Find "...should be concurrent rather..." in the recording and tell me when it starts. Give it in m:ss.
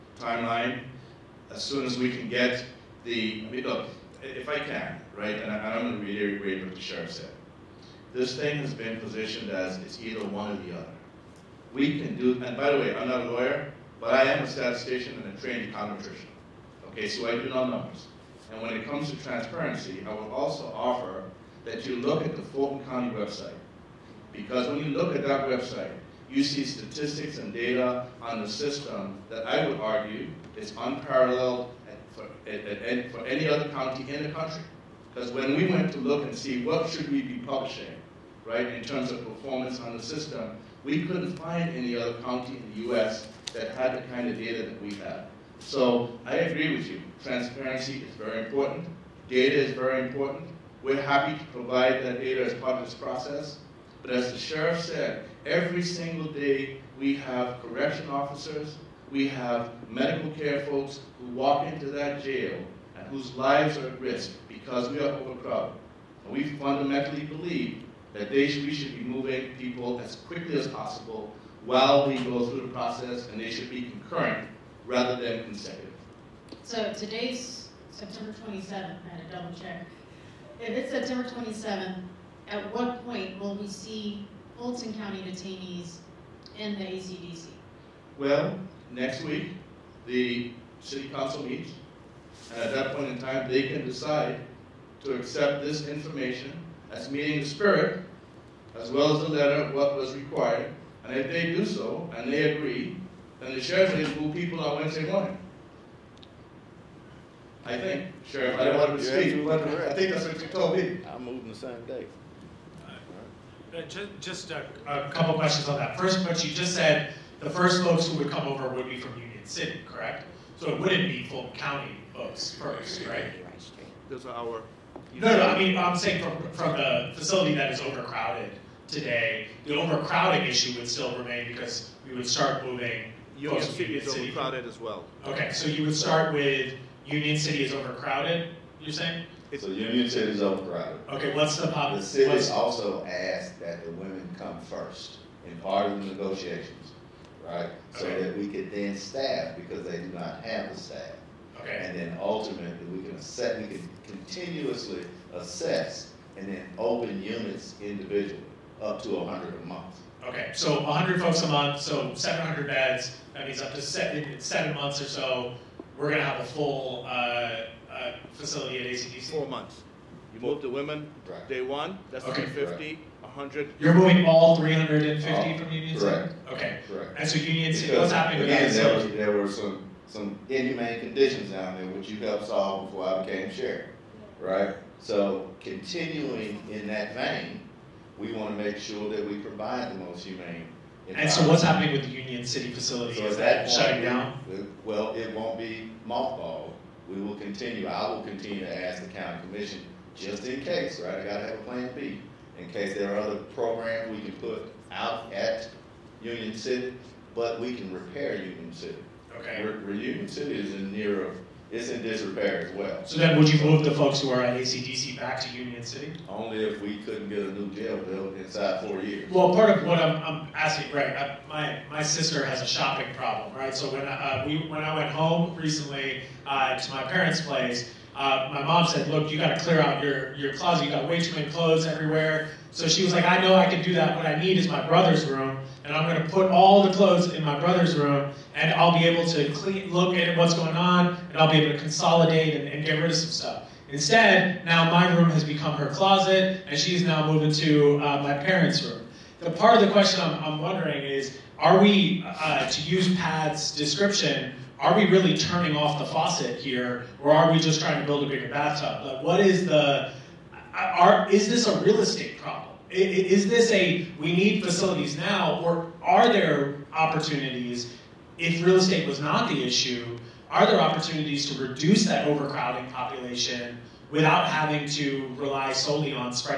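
1:13.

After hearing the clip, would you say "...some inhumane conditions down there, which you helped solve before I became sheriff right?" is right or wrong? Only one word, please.
right.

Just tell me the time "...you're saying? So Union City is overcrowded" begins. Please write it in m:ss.
2:18.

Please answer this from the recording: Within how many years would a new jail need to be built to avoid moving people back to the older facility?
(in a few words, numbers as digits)
4.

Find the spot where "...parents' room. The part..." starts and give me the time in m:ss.
4:08.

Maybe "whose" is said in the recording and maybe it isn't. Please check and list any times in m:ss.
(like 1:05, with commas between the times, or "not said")
1:03.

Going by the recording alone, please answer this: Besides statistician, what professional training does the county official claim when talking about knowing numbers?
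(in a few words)
econometrician.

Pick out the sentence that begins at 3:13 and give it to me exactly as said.
So is that, that shutting down?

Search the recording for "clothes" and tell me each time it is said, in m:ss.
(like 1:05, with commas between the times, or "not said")
3:51, 3:56.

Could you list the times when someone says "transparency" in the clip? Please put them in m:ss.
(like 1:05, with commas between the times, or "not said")
0:19, 0:47.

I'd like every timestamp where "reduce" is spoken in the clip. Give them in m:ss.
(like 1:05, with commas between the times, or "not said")
4:31.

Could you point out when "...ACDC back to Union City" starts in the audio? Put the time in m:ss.
3:34.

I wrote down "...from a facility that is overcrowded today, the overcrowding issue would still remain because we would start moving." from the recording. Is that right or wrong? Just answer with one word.
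right.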